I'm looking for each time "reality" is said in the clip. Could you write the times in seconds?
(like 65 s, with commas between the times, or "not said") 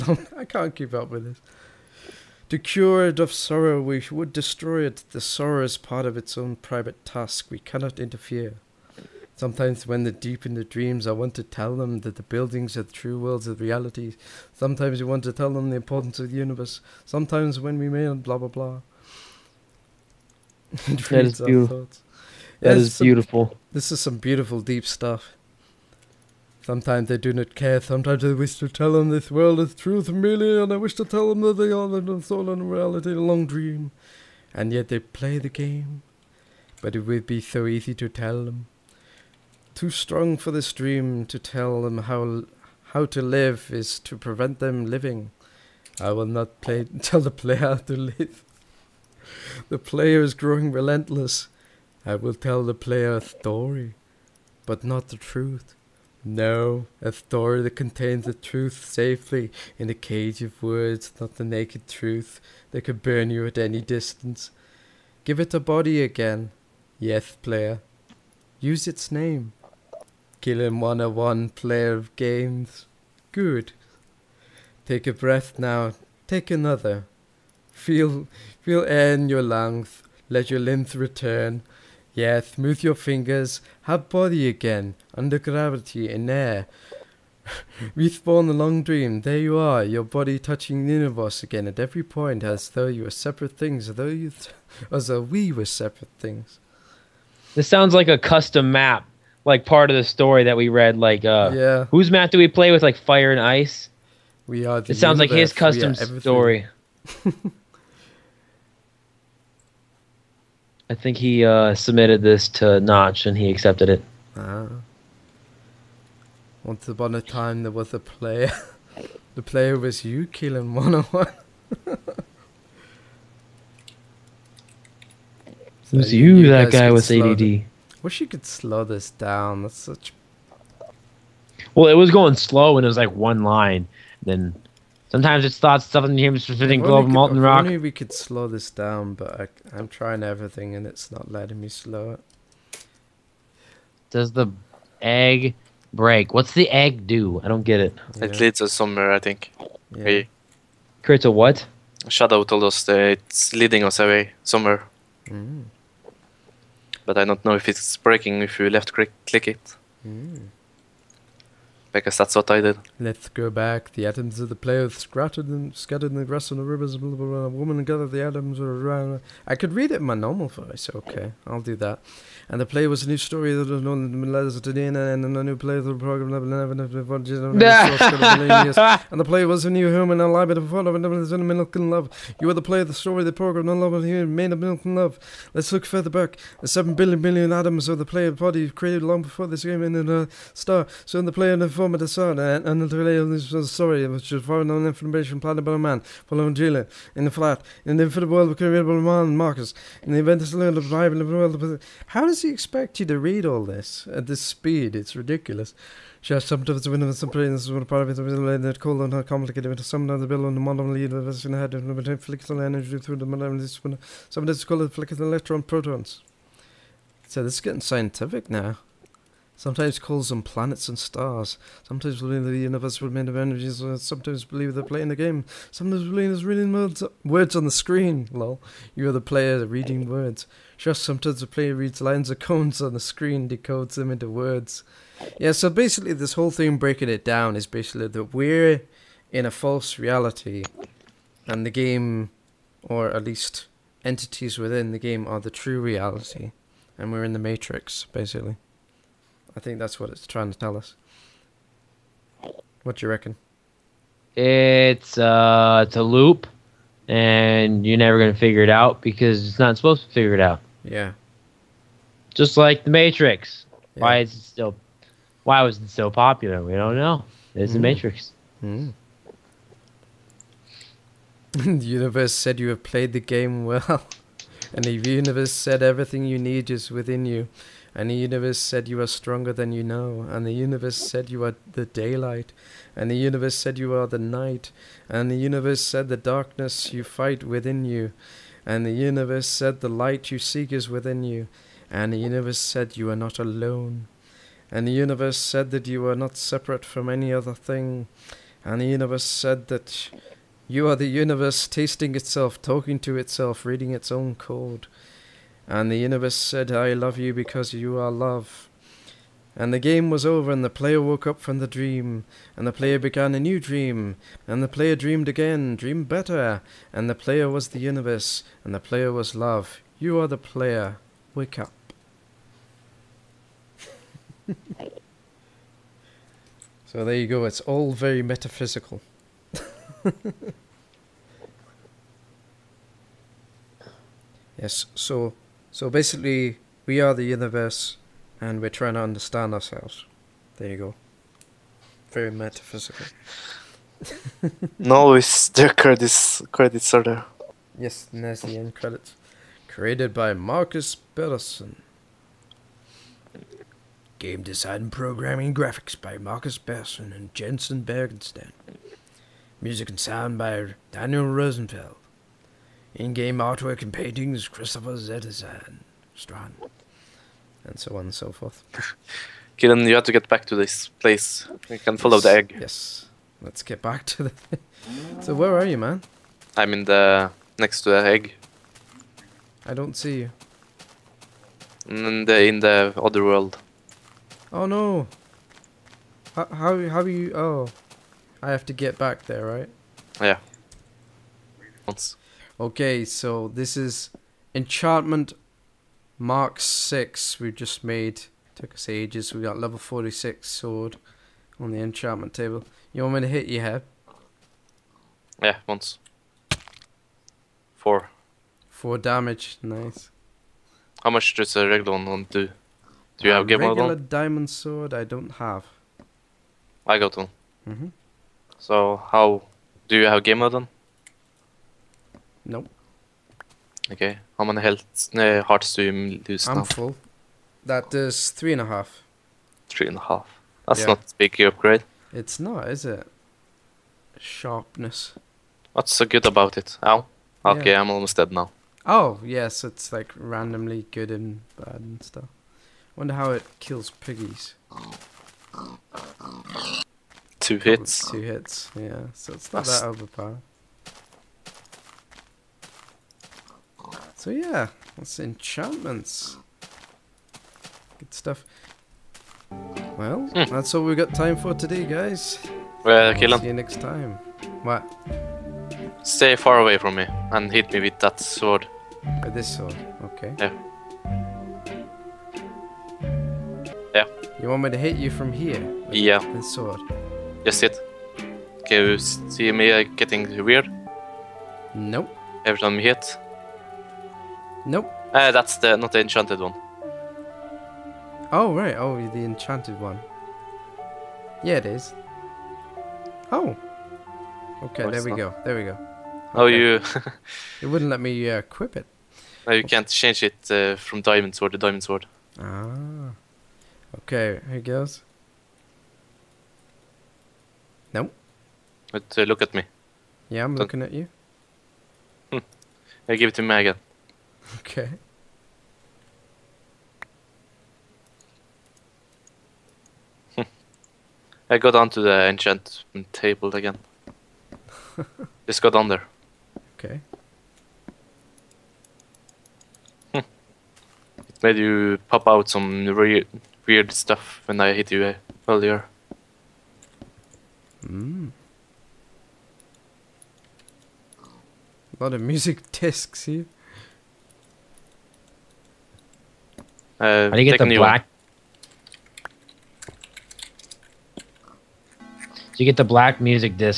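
13 s, 32 s, 239 s, 245 s.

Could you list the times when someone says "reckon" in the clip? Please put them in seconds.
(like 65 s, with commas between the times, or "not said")
253 s.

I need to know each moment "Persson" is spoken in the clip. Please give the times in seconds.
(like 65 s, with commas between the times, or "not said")
351 s, 356 s.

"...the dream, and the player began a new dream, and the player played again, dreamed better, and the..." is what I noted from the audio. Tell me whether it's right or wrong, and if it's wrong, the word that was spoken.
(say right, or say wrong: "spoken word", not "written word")
wrong: "dreamed", not "played".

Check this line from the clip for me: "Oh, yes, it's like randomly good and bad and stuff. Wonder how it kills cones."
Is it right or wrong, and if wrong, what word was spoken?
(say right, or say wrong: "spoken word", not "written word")
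wrong: "piggies", not "cones".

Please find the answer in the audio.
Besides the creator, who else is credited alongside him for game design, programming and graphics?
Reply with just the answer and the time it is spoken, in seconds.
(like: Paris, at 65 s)
Jensen Bergenstein, at 357 s.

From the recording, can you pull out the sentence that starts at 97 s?
This sounds like a custom map, like part of the story that we read.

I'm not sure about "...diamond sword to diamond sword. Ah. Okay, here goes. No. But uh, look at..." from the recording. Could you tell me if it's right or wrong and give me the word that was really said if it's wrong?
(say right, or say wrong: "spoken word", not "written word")
right.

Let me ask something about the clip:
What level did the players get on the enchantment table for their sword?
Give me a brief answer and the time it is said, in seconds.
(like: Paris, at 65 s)
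46, at 399 s.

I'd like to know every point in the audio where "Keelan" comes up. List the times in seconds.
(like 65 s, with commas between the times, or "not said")
70 s, 120 s.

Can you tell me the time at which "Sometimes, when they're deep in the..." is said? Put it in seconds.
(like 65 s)
9 s.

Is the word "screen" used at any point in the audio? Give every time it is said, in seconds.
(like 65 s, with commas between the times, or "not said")
227 s, 232 s.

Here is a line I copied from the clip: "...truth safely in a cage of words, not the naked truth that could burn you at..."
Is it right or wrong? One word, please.
right.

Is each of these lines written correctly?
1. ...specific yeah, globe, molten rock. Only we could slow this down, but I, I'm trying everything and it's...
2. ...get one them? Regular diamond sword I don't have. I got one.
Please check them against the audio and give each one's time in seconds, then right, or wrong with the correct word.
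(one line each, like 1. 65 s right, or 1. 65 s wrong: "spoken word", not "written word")
1. 136 s right
2. 413 s right.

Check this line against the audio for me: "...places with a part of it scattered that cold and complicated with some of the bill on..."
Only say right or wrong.
wrong.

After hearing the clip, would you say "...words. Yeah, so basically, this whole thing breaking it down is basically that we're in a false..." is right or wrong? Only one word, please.
right.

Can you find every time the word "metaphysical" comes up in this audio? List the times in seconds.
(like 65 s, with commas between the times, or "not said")
328 s, 342 s.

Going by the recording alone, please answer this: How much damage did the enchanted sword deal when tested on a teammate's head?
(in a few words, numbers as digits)
4.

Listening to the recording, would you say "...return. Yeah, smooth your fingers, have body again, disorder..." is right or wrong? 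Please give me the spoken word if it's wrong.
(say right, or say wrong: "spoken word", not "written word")
wrong: "under", not "disorder".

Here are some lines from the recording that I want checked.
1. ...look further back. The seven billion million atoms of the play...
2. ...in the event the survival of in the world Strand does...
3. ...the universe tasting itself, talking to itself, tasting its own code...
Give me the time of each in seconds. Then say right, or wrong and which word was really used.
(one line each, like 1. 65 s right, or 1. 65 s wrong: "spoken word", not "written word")
1. 185 s right
2. 200 s wrong: "How", not "Strand"
3. 300 s wrong: "reading", not "tasting".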